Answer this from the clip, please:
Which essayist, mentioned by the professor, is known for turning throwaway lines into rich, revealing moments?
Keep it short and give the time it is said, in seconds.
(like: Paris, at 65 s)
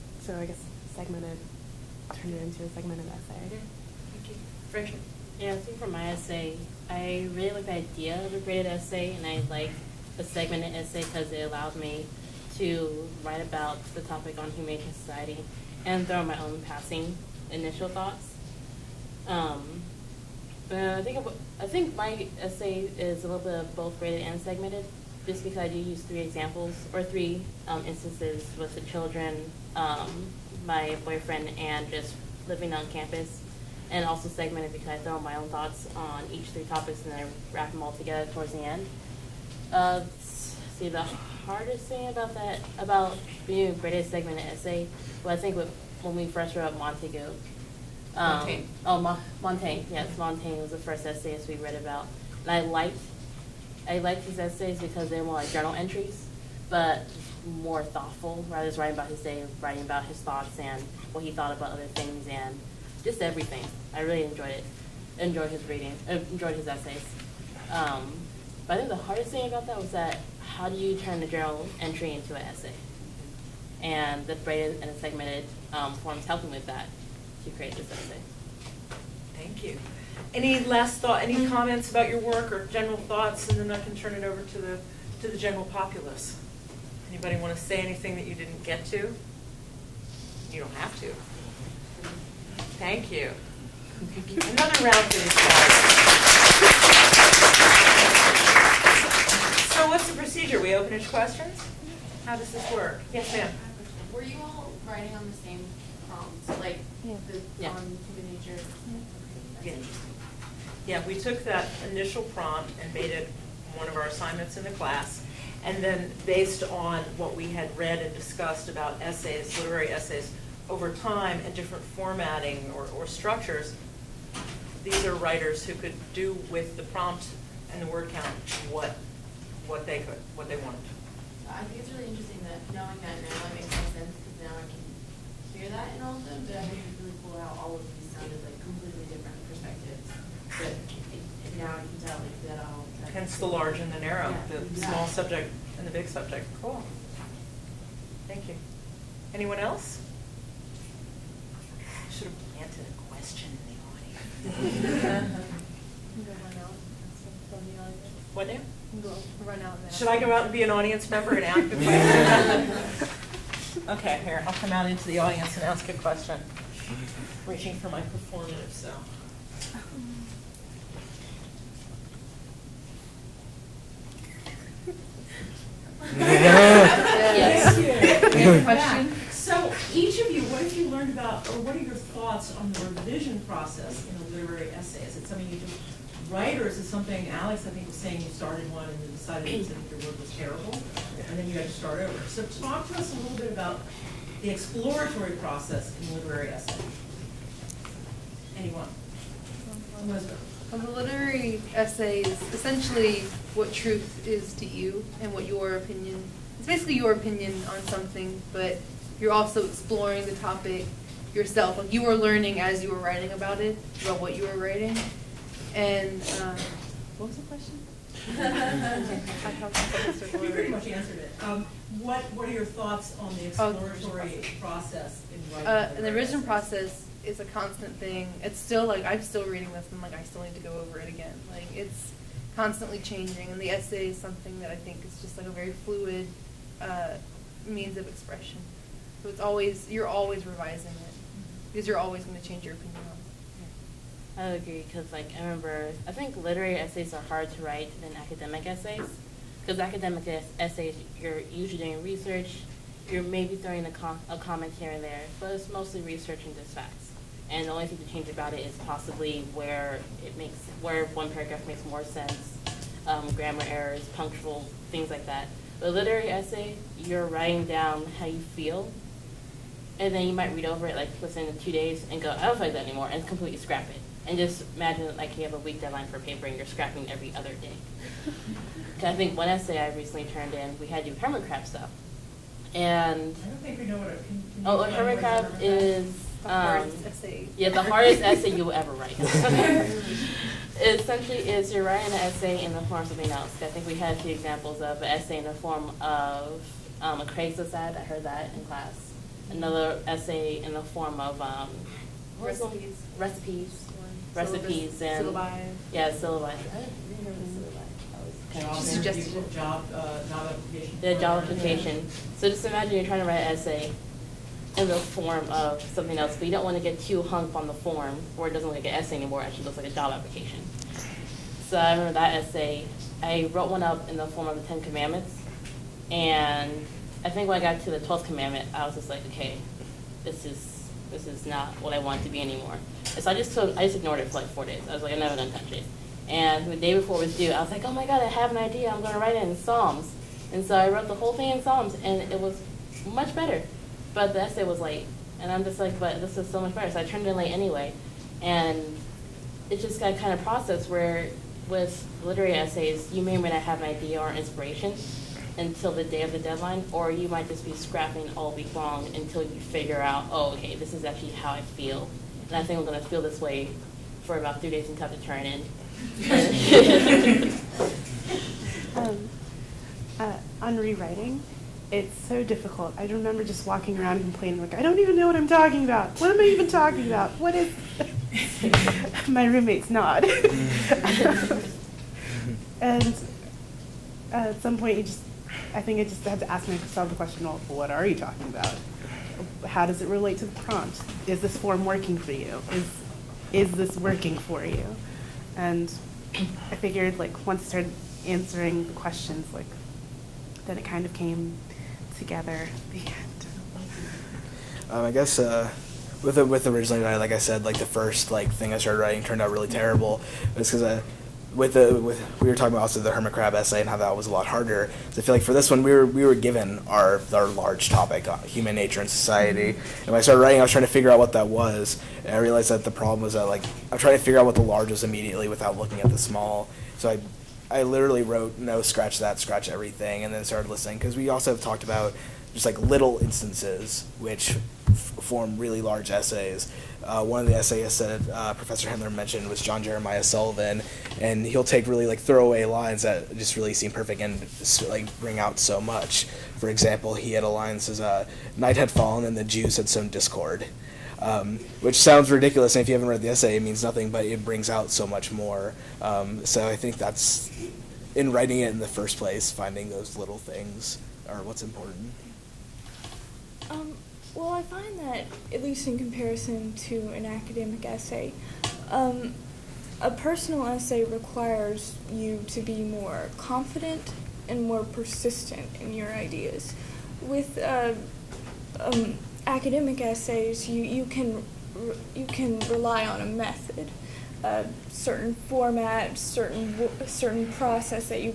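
John Jeremiah Sullivan, at 439 s.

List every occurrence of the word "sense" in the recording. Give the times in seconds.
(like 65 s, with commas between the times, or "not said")
133 s, 262 s.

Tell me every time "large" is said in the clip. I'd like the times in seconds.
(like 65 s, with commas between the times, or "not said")
143 s, 417 s, 424 s, 435 s.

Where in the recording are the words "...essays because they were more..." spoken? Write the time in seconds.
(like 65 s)
54 s.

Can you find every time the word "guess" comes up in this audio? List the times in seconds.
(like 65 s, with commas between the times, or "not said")
0 s, 405 s.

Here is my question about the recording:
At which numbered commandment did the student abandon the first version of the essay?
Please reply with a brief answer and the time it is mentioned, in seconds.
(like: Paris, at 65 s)
12th, at 327 s.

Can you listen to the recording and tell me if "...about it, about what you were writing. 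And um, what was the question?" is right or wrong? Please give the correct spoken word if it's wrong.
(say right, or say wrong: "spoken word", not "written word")
right.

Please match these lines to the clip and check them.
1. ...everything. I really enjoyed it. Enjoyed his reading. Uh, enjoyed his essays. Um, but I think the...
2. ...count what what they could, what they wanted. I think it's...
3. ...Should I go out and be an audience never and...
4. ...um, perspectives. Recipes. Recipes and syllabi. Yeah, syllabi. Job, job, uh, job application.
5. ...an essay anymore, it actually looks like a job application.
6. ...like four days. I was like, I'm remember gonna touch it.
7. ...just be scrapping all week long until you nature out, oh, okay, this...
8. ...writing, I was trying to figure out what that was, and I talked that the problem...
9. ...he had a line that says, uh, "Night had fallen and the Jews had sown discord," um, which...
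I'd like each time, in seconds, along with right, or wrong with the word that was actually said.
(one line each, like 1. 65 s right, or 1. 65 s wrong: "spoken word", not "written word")
1. 63 s right
2. 128 s right
3. 159 s wrong: "member", not "never"
4. 301 s wrong: "recipes", not "perspectives"
5. 318 s right
6. 334 s wrong: "never", not "remember"
7. 357 s wrong: "figure", not "nature"
8. 420 s wrong: "realized", not "talked"
9. 447 s right.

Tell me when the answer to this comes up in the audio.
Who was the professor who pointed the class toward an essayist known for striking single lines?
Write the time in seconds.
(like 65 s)
438 s.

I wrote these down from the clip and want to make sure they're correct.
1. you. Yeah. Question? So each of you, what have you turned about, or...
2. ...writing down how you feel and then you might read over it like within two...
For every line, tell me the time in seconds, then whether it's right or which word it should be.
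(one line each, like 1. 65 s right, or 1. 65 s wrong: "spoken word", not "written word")
1. 178 s wrong: "learned", not "turned"
2. 267 s right.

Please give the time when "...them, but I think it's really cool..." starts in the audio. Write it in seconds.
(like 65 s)
136 s.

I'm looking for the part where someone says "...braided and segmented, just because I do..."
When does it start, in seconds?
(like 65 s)
23 s.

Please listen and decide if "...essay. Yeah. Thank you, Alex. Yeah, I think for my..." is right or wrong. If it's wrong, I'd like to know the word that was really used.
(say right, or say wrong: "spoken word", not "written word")
wrong: "Rachel", not "Alex".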